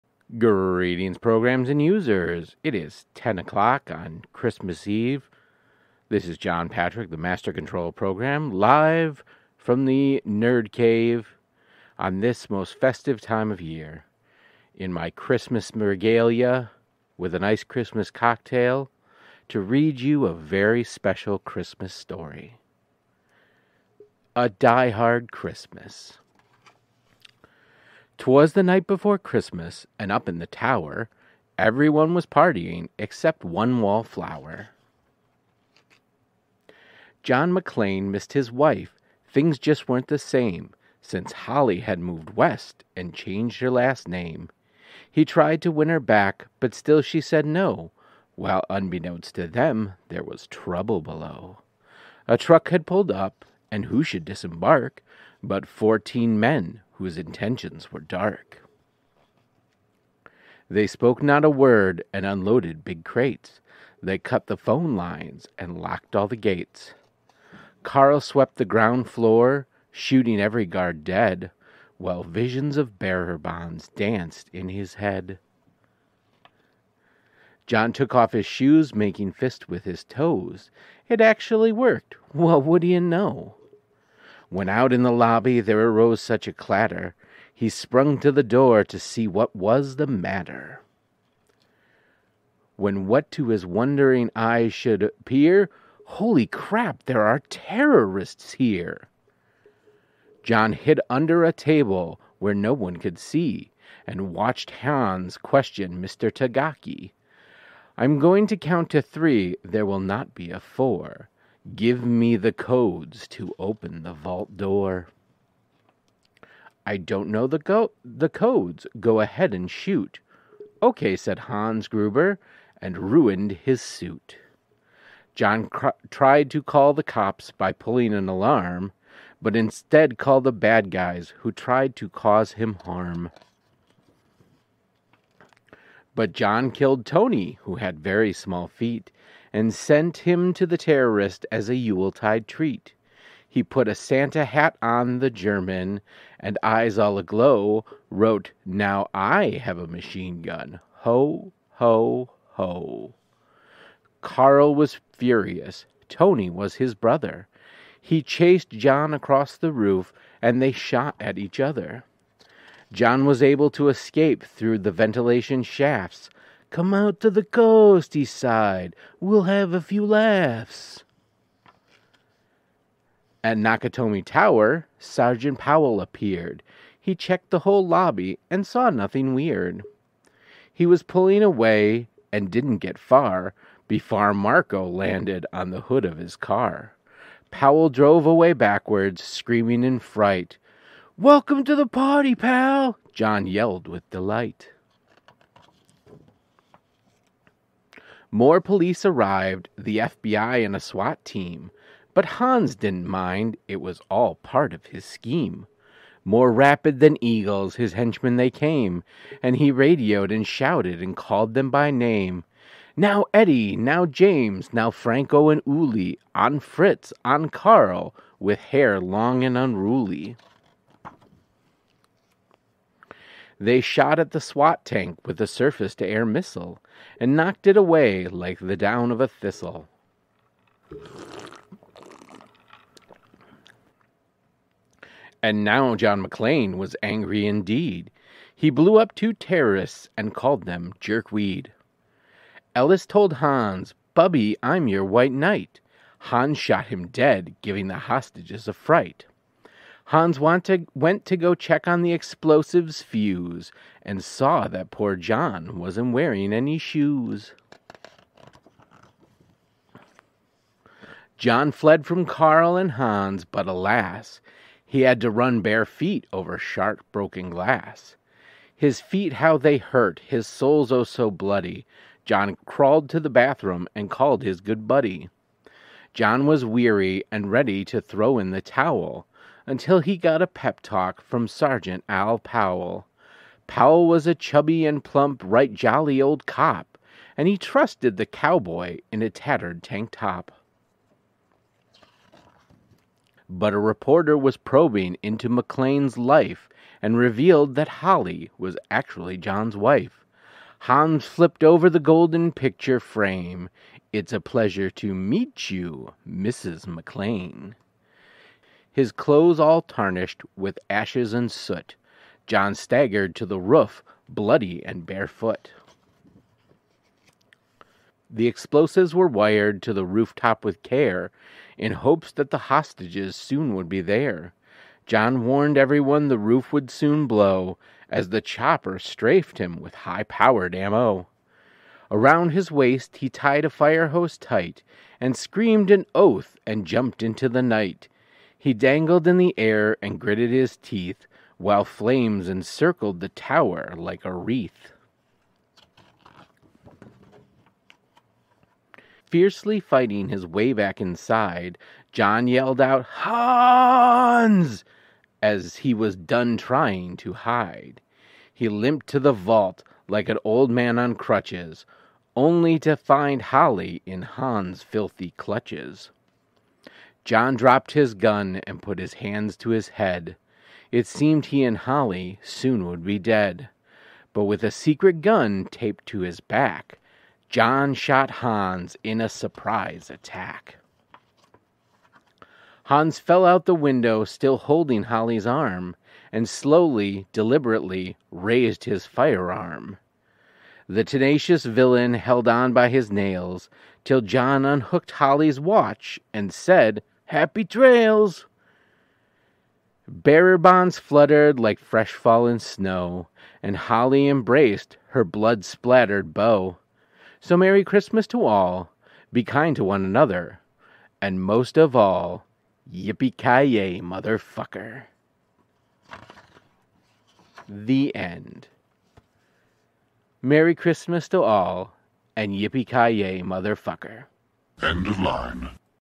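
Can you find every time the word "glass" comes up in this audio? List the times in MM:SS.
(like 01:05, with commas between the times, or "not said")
04:27.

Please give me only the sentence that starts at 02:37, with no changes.
He chased John across the roof and they shot at each other.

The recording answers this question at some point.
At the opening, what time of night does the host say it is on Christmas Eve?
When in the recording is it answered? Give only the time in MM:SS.
00:03.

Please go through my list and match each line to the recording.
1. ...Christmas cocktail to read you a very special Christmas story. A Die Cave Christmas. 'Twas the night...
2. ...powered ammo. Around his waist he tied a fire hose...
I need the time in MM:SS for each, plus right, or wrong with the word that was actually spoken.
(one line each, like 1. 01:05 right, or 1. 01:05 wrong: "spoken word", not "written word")
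1. 00:17 wrong: "Hard", not "Cave"
2. 05:30 right.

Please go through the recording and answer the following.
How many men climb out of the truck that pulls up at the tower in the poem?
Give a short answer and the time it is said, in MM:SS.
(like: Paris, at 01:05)
14, at 00:55.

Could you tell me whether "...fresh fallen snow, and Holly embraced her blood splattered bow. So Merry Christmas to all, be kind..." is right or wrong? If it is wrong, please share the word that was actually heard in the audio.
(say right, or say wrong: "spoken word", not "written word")
right.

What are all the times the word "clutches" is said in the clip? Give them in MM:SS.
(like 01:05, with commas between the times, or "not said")
06:05.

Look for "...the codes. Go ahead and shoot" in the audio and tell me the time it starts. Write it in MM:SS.
01:58.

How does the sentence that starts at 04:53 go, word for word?
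But a reporter was probing into McClane's life and revealed that Holly was actually John's wife.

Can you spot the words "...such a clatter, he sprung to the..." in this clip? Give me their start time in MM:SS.
01:26.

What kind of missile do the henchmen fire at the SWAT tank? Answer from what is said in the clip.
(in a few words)
Surface to air.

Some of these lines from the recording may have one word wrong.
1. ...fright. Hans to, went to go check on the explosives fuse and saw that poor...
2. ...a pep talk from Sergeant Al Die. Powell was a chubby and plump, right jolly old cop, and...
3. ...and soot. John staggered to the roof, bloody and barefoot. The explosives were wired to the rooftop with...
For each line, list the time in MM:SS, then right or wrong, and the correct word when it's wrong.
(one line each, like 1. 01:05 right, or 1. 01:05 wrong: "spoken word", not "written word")
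1. 04:08 right
2. 04:40 wrong: "Powell", not "Die"
3. 05:11 right.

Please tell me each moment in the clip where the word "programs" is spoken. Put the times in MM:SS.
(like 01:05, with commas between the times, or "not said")
00:01, 00:07.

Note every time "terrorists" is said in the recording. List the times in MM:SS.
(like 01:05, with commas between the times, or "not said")
01:37, 02:20, 03:59.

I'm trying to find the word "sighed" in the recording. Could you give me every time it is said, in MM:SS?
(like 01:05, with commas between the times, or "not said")
02:48.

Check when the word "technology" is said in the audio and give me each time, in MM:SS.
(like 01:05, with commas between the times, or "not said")
not said.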